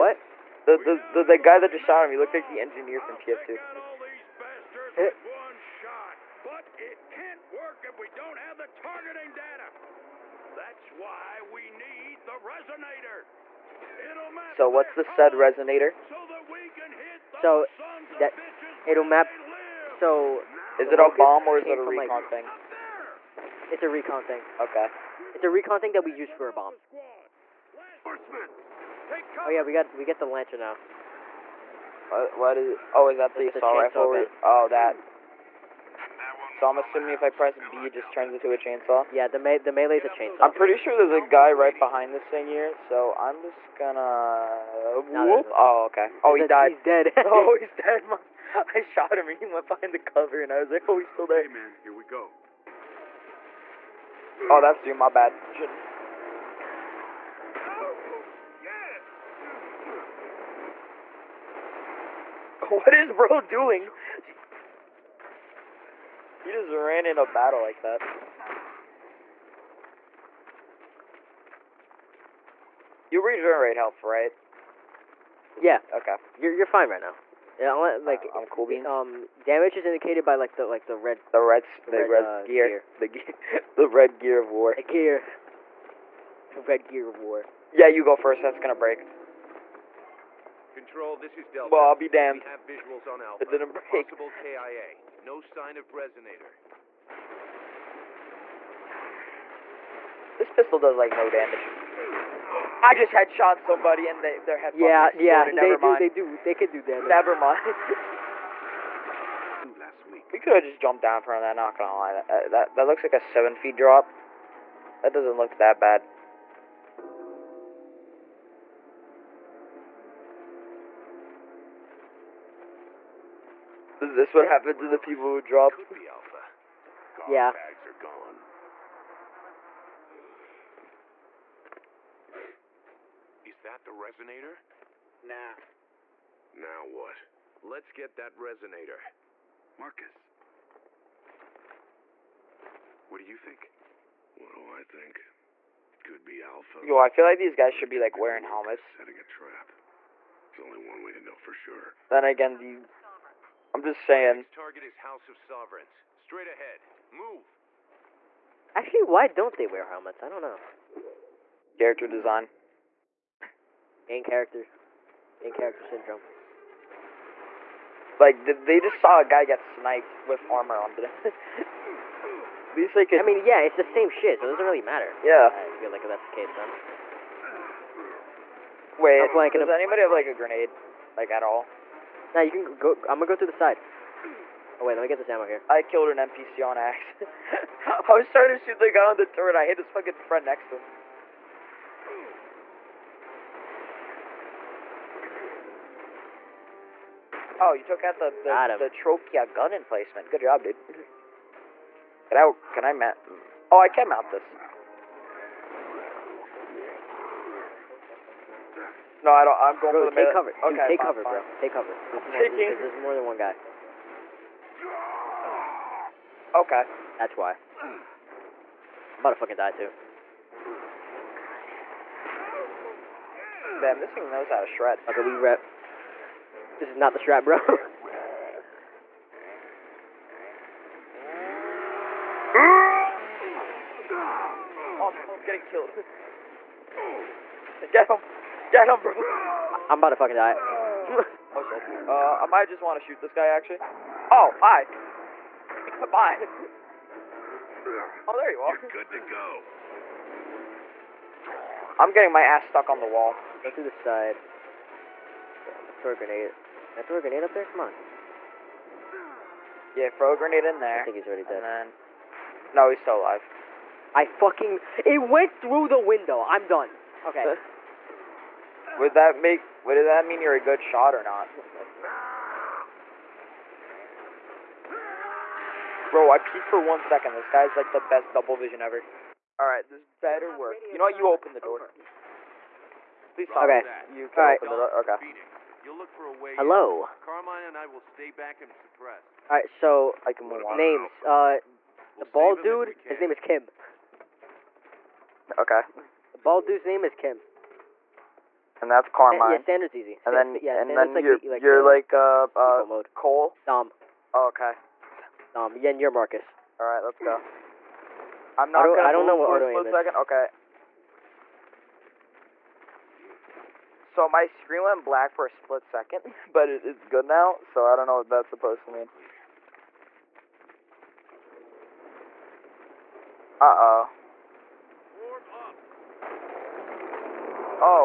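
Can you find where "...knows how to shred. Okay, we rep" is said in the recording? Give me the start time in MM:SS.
03:44.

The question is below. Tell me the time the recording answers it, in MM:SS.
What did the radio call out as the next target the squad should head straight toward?
02:34.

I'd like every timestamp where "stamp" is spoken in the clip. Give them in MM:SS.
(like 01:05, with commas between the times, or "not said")
not said.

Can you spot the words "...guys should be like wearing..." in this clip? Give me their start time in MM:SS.
02:27.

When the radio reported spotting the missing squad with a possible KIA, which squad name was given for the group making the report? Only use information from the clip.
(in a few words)
Delta.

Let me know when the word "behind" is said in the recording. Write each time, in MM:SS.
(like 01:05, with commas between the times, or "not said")
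00:41, 00:49.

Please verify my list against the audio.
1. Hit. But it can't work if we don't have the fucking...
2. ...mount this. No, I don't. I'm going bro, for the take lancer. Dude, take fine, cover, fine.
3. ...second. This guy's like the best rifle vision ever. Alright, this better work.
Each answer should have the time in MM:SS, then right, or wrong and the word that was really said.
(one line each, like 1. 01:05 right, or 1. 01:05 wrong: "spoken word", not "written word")
1. 00:04 wrong: "targeting", not "fucking"
2. 03:24 wrong: "cover", not "lancer"
3. 04:36 wrong: "double", not "rifle".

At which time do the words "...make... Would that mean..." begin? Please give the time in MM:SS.
04:29.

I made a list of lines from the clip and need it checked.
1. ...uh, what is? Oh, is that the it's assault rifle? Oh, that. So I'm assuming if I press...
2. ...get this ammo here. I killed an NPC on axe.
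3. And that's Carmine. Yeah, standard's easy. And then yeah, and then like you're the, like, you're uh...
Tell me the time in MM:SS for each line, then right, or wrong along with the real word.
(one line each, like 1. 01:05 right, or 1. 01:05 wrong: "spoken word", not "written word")
1. 00:32 right
2. 03:05 right
3. 04:58 right.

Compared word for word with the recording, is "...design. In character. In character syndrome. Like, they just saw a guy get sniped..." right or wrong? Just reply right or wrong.
right.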